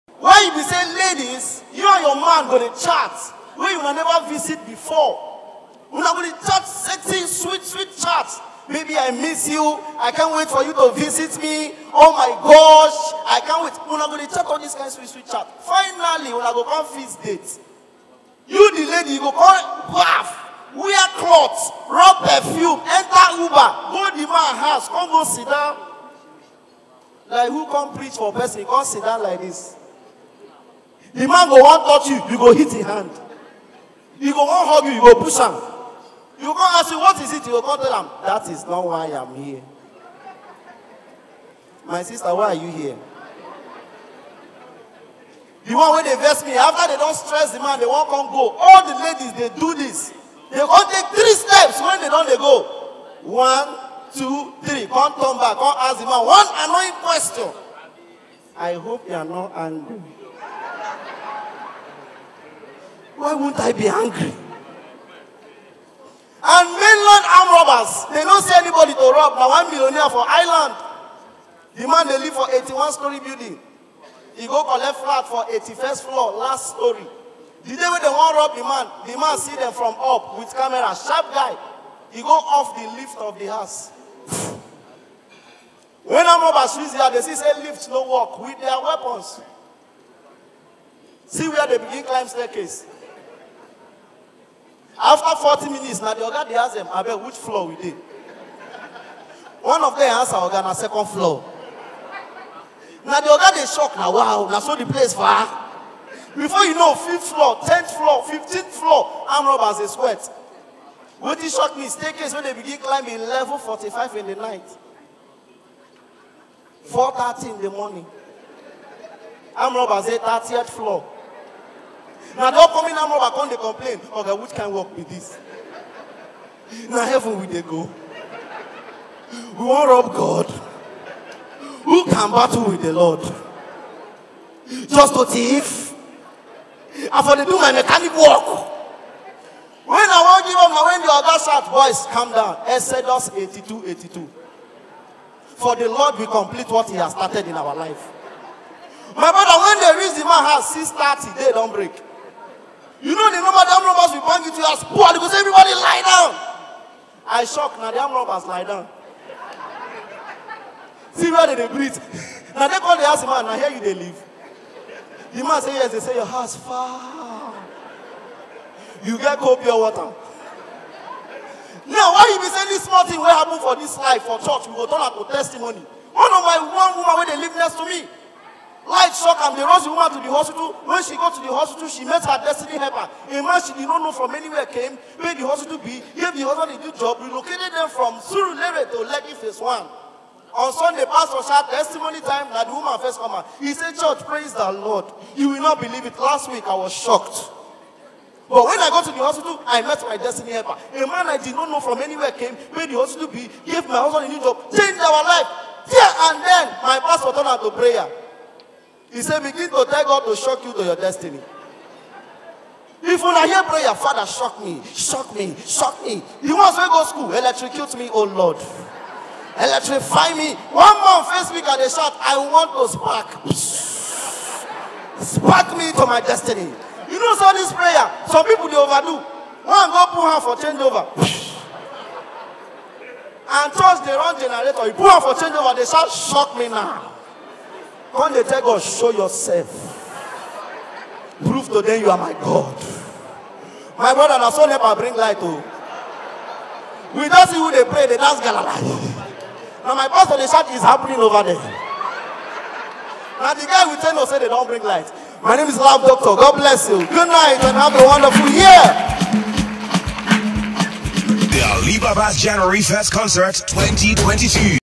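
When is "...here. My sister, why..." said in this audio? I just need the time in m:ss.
0:39.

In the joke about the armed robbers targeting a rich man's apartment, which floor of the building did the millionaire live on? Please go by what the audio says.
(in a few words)
81st floor.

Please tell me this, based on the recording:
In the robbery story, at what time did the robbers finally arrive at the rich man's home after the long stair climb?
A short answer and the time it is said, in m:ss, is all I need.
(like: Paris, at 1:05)
6:30, at 2:30.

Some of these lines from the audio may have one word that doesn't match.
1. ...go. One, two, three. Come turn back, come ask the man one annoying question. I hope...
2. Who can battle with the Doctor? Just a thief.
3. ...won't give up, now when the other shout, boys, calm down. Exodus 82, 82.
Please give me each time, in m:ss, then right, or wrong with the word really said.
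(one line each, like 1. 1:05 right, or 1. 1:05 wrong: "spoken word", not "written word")
1. 0:52 right
2. 2:11 wrong: "Lord", not "Doctor"
3. 2:20 right.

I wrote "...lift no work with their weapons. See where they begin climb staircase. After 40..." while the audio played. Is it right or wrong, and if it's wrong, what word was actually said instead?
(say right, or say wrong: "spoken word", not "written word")
right.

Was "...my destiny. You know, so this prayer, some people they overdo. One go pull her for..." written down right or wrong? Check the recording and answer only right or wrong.
right.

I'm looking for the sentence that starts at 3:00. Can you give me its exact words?
When she got to the hospital, she met her destiny helper.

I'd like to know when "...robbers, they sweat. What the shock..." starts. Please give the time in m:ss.
1:49.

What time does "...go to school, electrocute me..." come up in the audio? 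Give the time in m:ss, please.
3:36.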